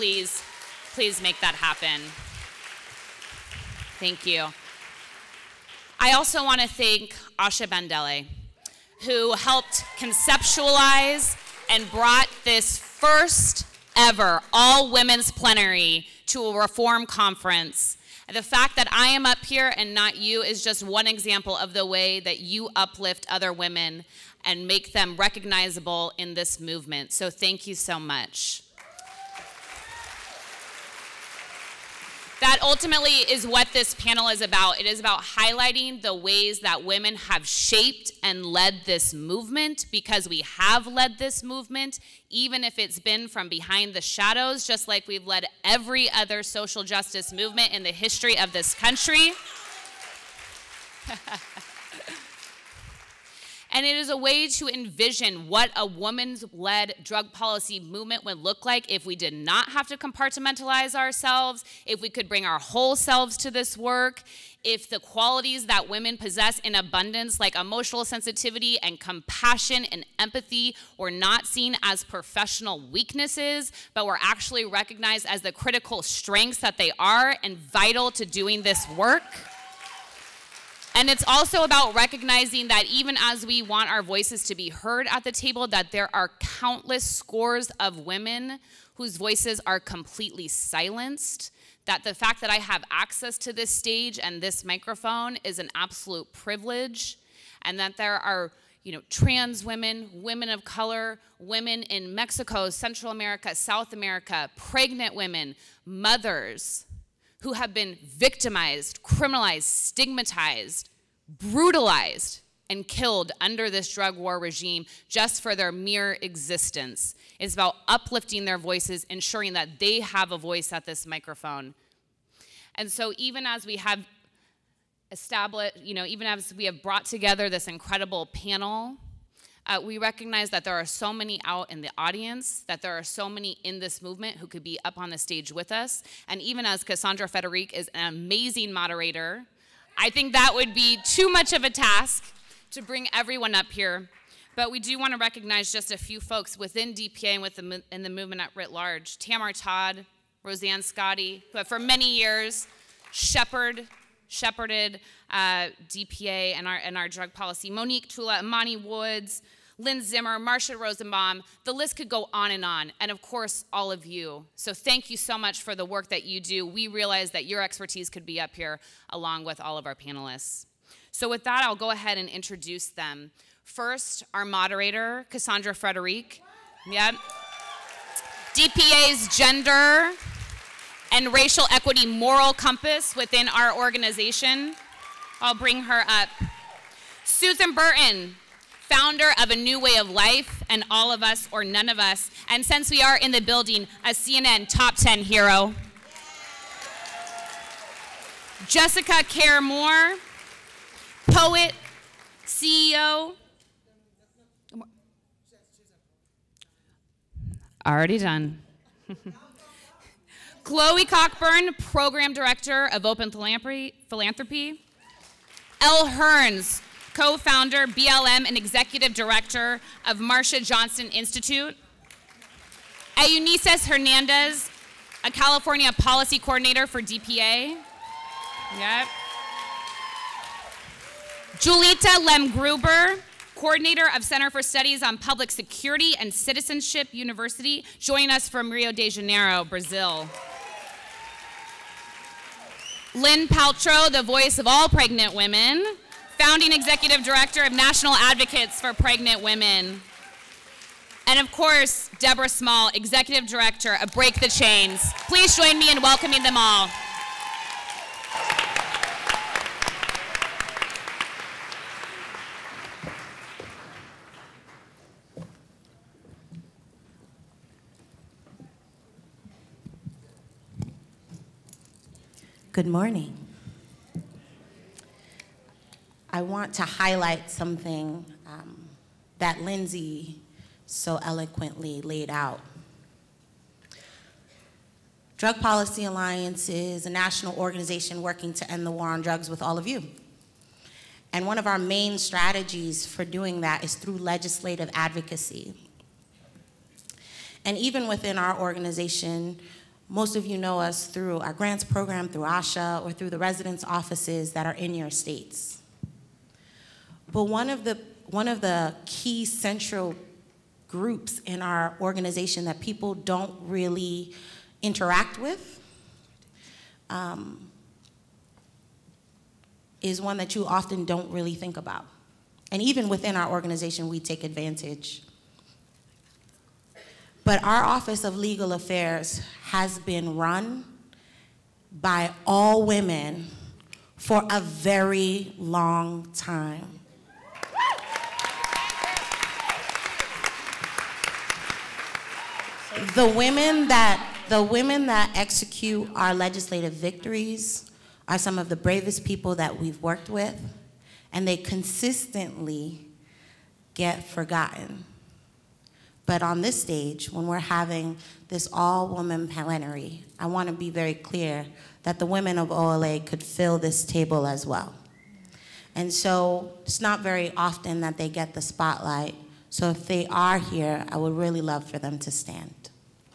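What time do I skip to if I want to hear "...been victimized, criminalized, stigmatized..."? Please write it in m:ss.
1:47.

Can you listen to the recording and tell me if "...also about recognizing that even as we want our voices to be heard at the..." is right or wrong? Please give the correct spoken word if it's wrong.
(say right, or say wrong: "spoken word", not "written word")
right.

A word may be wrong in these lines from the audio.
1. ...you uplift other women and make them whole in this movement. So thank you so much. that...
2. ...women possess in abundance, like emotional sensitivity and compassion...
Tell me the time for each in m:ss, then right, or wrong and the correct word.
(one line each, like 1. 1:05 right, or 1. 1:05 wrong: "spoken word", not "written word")
1. 0:22 wrong: "recognizable", not "whole"
2. 1:05 right.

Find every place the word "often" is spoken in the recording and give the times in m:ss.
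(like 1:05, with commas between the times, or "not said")
5:20, 6:07.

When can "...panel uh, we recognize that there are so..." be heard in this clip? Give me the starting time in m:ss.
2:08.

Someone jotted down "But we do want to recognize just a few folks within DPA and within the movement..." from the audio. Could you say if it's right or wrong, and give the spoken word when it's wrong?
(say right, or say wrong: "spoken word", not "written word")
right.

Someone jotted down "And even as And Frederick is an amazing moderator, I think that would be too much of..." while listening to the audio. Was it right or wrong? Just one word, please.
wrong.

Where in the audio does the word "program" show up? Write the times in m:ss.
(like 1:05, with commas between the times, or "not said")
3:31, 5:01.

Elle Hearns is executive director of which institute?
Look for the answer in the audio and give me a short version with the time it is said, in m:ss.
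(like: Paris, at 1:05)
Marsha Johnson Institute, at 3:40.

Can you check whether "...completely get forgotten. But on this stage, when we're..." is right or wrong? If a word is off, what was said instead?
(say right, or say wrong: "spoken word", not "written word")
wrong: "consistently", not "completely".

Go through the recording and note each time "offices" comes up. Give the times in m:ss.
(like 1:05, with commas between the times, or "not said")
5:03, 5:27.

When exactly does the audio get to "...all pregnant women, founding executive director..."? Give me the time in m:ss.
4:04.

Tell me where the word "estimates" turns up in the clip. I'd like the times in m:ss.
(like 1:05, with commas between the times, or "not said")
not said.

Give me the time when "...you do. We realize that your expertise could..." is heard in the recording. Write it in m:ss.
2:46.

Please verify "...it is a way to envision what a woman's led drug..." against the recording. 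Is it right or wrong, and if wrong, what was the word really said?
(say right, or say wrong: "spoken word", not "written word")
right.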